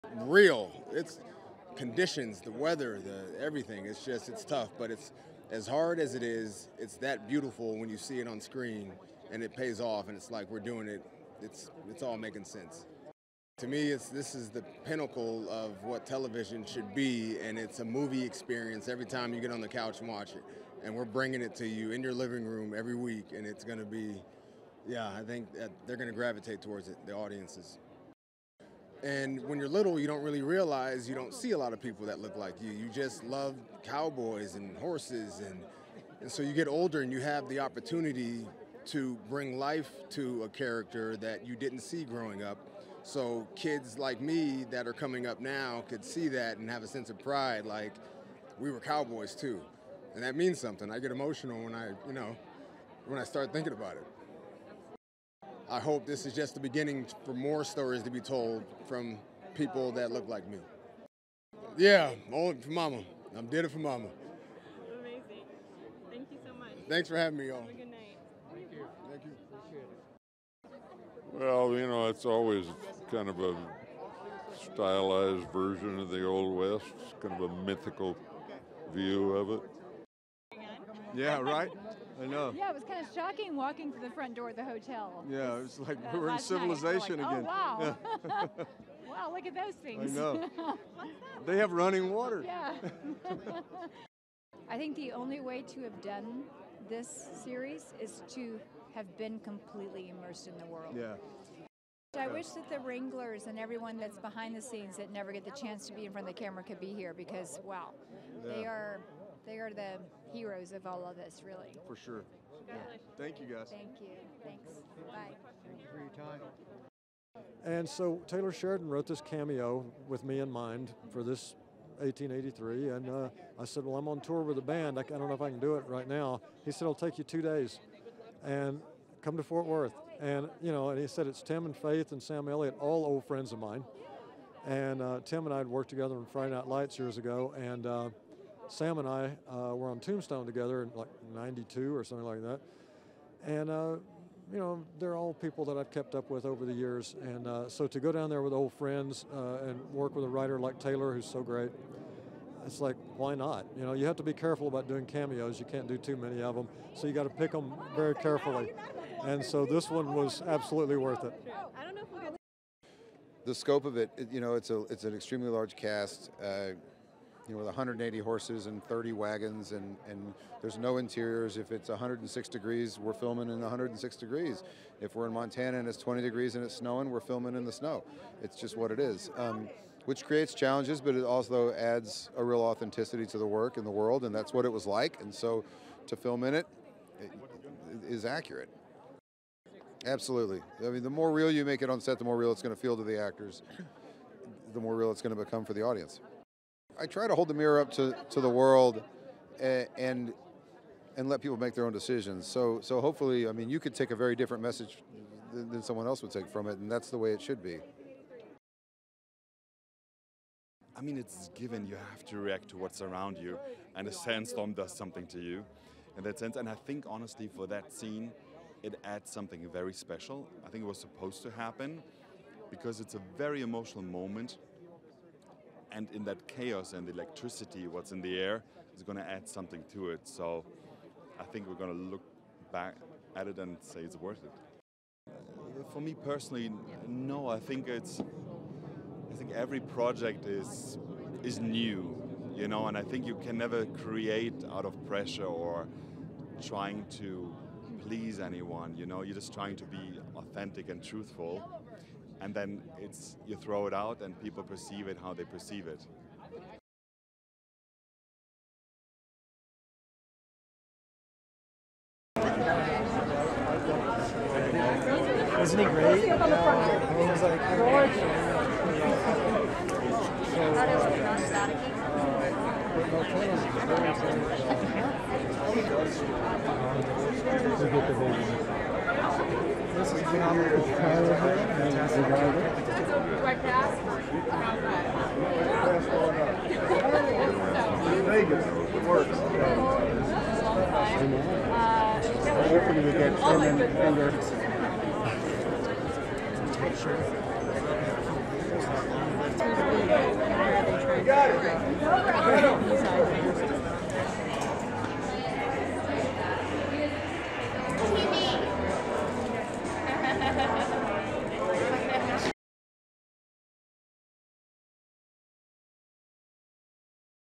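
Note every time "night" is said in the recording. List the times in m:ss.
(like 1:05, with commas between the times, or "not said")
1:07, 2:16.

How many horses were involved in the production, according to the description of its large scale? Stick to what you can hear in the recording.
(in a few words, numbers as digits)
180.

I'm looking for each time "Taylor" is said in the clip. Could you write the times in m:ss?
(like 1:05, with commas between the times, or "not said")
1:58, 2:30.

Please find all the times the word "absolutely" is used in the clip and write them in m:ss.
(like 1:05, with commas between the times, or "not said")
2:40, 3:10.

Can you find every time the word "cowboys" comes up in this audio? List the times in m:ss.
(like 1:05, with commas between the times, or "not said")
0:33, 0:48.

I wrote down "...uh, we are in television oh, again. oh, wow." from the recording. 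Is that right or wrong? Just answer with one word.
wrong.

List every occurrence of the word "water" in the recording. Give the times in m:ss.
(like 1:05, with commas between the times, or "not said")
1:32.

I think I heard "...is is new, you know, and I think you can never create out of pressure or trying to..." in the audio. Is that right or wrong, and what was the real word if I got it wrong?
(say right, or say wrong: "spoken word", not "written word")
right.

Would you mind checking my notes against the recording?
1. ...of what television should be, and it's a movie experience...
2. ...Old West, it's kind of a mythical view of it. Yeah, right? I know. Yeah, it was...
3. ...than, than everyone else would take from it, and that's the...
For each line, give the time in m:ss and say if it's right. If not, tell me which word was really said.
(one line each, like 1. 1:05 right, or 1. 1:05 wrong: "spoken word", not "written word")
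1. 0:15 right
2. 1:16 right
3. 3:25 wrong: "someone", not "everyone".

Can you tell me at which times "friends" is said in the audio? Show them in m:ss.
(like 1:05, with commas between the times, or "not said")
2:13, 2:28.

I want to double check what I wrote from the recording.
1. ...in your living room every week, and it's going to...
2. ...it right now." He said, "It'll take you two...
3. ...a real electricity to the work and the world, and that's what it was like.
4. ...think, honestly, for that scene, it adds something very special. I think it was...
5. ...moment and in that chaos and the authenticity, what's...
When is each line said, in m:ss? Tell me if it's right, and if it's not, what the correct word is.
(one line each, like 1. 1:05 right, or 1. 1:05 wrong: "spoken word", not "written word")
1. 0:21 right
2. 2:05 right
3. 3:02 wrong: "authenticity", not "electricity"
4. 3:36 right
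5. 3:44 wrong: "electricity", not "authenticity".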